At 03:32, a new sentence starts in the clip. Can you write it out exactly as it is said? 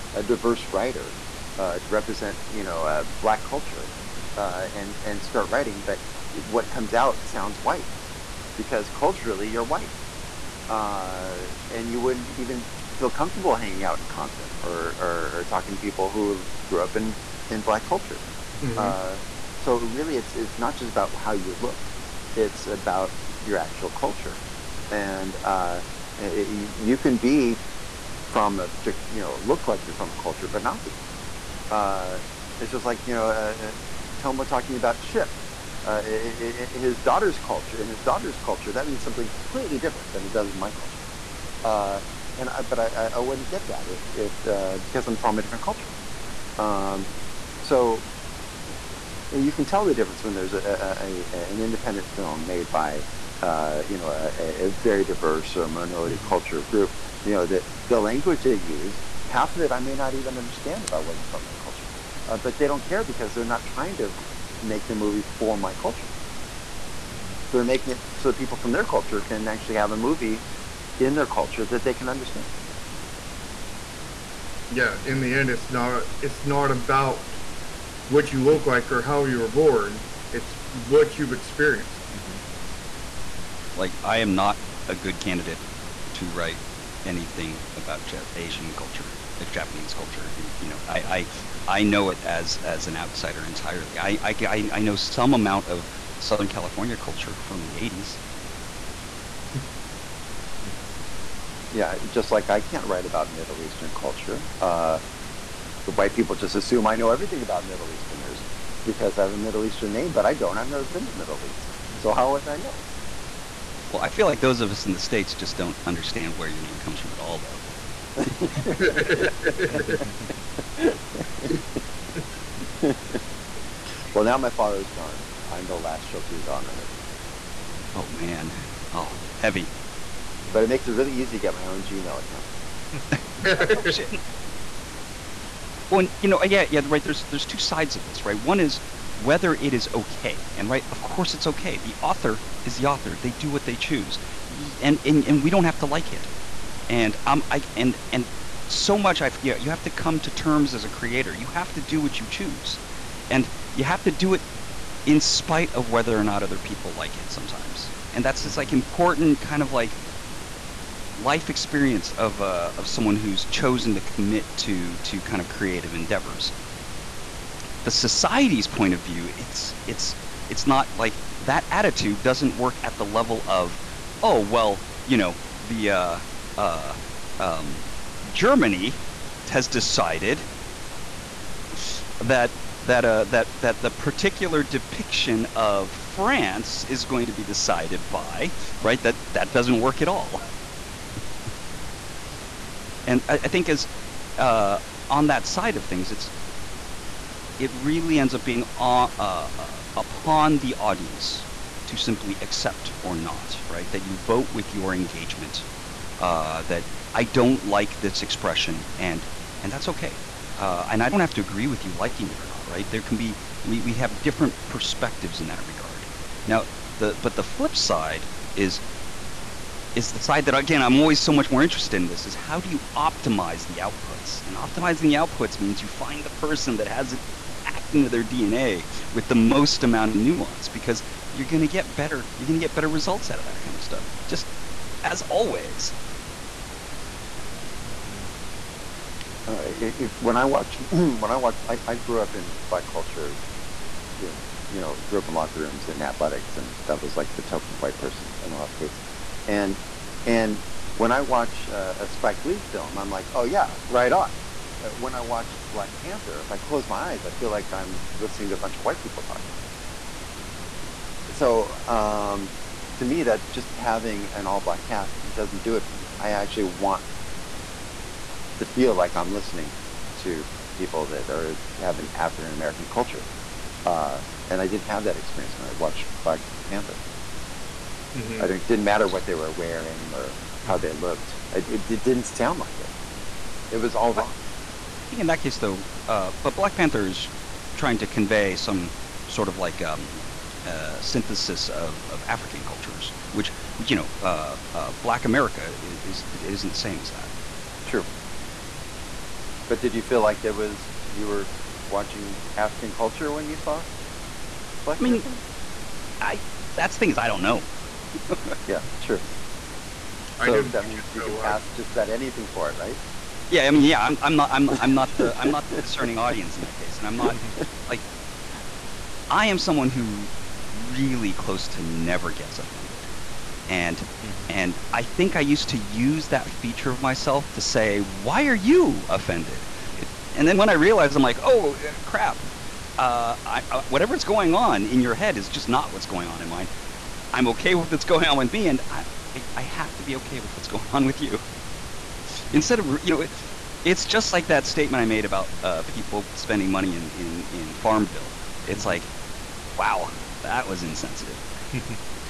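There can be we we have different perspectives in that regard.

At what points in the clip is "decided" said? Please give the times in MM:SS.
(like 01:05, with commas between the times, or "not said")
02:59, 03:07.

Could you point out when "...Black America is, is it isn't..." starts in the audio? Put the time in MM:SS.
04:55.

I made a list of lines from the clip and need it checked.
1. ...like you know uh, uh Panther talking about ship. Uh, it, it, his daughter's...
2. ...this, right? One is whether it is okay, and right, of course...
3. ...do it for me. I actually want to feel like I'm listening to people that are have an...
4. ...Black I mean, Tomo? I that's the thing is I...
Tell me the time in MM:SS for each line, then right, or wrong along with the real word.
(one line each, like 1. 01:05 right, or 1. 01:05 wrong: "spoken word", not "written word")
1. 00:32 wrong: "Tomo", not "Panther"
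2. 02:18 right
3. 04:25 right
4. 05:04 wrong: "Panther", not "Tomo".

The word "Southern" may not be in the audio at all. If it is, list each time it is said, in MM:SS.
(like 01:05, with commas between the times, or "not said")
01:36.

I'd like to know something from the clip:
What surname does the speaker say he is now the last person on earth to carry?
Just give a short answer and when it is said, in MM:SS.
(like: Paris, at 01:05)
Shokrizade, at 02:06.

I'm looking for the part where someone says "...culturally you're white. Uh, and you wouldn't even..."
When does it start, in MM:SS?
00:08.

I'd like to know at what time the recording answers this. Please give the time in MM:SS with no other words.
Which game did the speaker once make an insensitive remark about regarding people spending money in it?
05:47.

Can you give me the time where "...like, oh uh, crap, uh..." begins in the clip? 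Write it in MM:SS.
05:31.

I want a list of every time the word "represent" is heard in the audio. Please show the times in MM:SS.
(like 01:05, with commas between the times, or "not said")
00:01.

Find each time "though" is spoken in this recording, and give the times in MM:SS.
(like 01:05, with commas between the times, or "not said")
01:57, 04:45.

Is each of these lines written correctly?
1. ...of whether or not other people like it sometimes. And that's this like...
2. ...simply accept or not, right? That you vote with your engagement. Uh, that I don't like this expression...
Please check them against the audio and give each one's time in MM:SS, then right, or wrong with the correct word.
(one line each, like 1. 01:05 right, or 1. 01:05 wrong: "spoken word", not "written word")
1. 02:35 right
2. 03:21 right.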